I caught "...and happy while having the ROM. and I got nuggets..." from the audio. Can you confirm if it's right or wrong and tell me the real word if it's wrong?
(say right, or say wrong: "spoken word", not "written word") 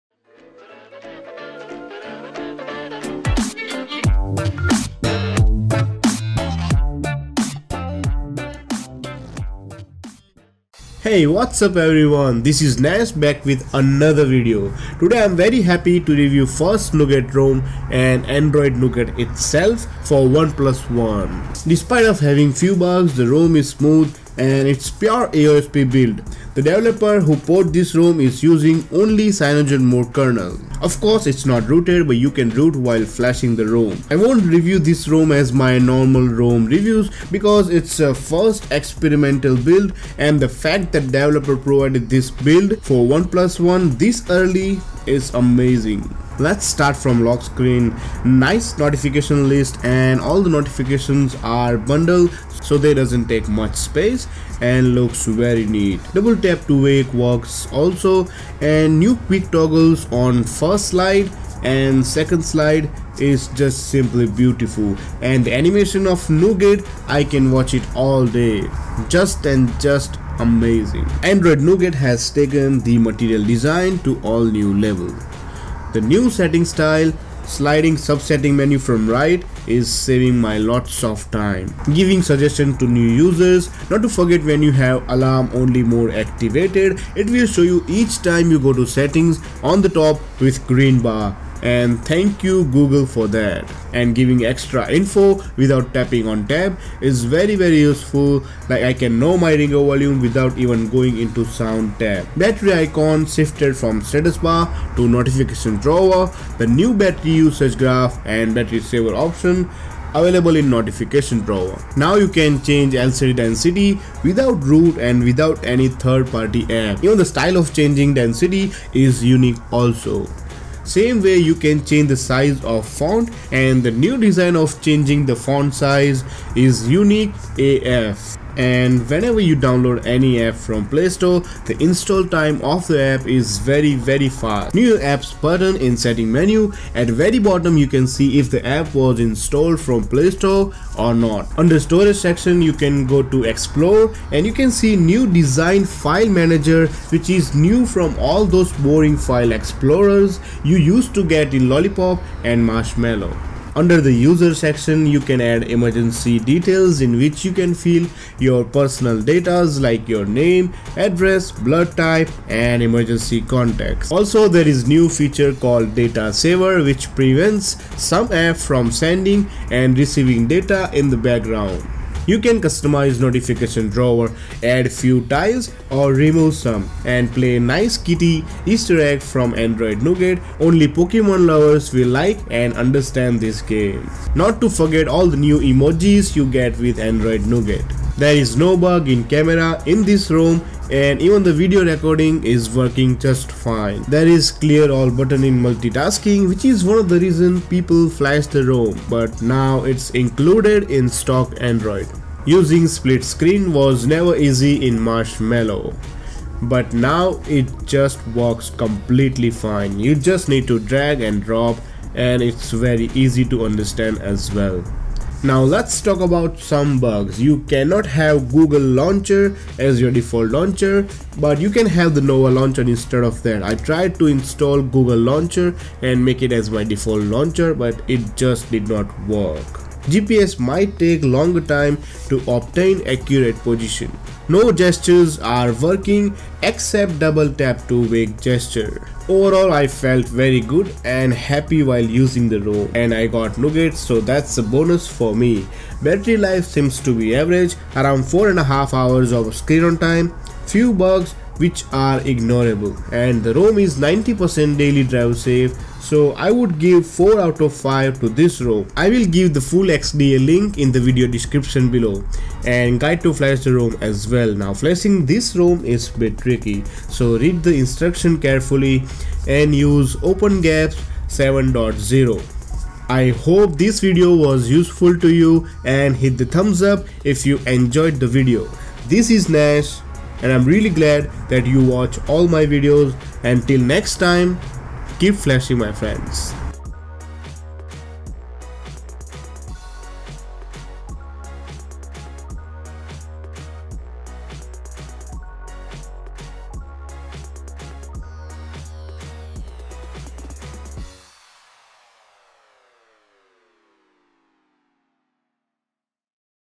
wrong: "using", not "having".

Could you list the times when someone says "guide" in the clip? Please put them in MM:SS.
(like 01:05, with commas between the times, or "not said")
04:22.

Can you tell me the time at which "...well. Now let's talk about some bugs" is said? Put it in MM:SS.
03:34.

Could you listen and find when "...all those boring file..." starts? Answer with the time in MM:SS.
02:28.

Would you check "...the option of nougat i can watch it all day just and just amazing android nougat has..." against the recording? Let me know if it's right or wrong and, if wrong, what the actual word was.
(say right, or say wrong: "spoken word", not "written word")
wrong: "animation", not "option".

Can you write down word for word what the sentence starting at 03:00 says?
Only Pokemon lovers will like and understand this game.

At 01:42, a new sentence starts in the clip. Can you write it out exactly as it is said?
Battery icon shifted from status bar to notification drawer, the new battery usage graph and battery saver option available in notification drawer.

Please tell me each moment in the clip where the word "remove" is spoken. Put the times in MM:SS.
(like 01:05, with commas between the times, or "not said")
02:56.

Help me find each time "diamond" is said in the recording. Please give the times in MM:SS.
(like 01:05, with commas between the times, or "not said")
not said.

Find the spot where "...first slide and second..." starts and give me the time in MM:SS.
01:00.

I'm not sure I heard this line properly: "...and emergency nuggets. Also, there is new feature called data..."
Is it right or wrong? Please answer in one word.
wrong.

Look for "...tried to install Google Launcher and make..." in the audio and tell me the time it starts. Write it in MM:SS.
03:43.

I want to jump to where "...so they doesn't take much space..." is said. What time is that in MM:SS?
00:52.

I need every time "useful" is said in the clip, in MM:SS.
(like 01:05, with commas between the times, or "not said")
01:37, 04:34.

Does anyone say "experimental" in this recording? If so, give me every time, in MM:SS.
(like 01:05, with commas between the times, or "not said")
00:38.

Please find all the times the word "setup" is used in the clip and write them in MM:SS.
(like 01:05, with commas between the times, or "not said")
not said.